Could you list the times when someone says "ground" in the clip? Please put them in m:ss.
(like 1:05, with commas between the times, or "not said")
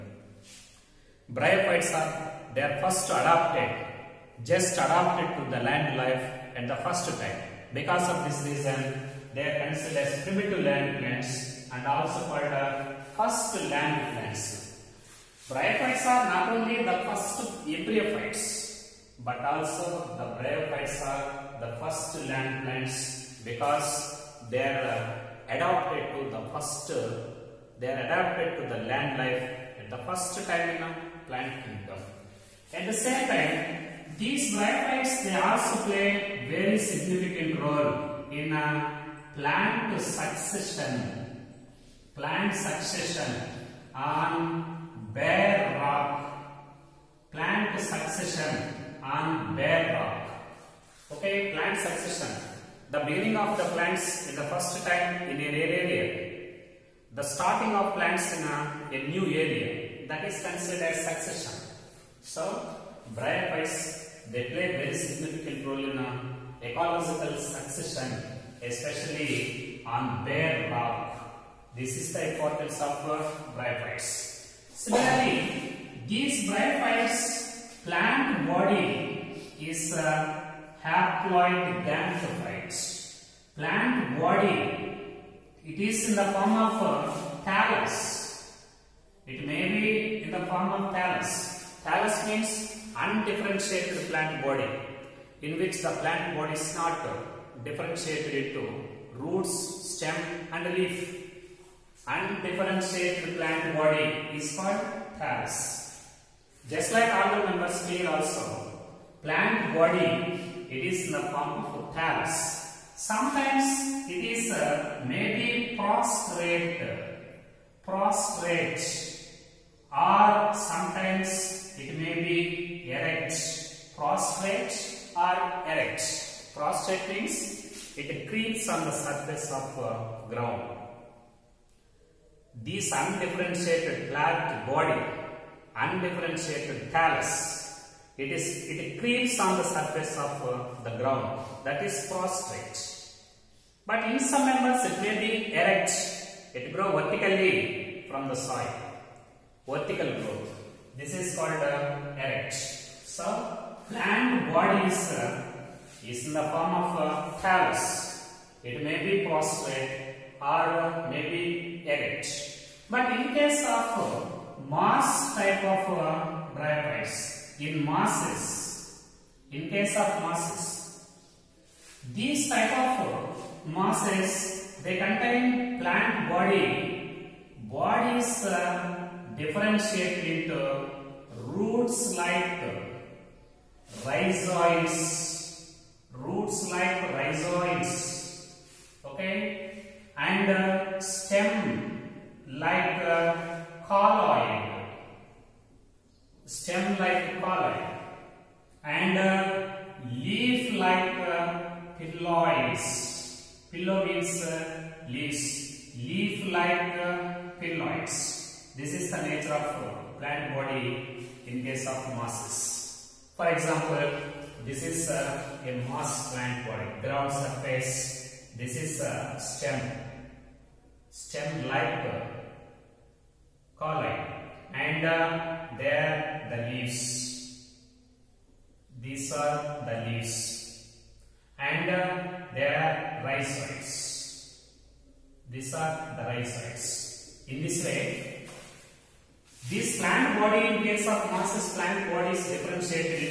2:10, 2:20, 3:36.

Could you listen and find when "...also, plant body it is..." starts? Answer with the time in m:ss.
1:48.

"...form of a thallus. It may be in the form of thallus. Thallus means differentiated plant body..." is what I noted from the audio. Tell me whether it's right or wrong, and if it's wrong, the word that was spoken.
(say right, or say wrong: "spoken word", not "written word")
wrong: "undifferentiated", not "differentiated".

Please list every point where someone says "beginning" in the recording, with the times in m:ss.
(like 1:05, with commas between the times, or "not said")
0:52.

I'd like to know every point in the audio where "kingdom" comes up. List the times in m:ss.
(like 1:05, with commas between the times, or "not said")
0:31.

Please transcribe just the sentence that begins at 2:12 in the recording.
This undifferentiated flat body, undifferentiated thallus.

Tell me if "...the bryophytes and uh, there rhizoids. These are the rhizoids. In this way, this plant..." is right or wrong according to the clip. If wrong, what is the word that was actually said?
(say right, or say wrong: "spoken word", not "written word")
wrong: "leaves", not "bryophytes".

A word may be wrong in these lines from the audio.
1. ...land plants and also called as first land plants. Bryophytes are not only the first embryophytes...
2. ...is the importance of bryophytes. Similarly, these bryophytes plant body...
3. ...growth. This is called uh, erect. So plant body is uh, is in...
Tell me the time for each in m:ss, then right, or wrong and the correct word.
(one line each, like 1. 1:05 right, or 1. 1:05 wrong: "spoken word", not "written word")
1. 0:10 right
2. 1:11 right
3. 2:30 right.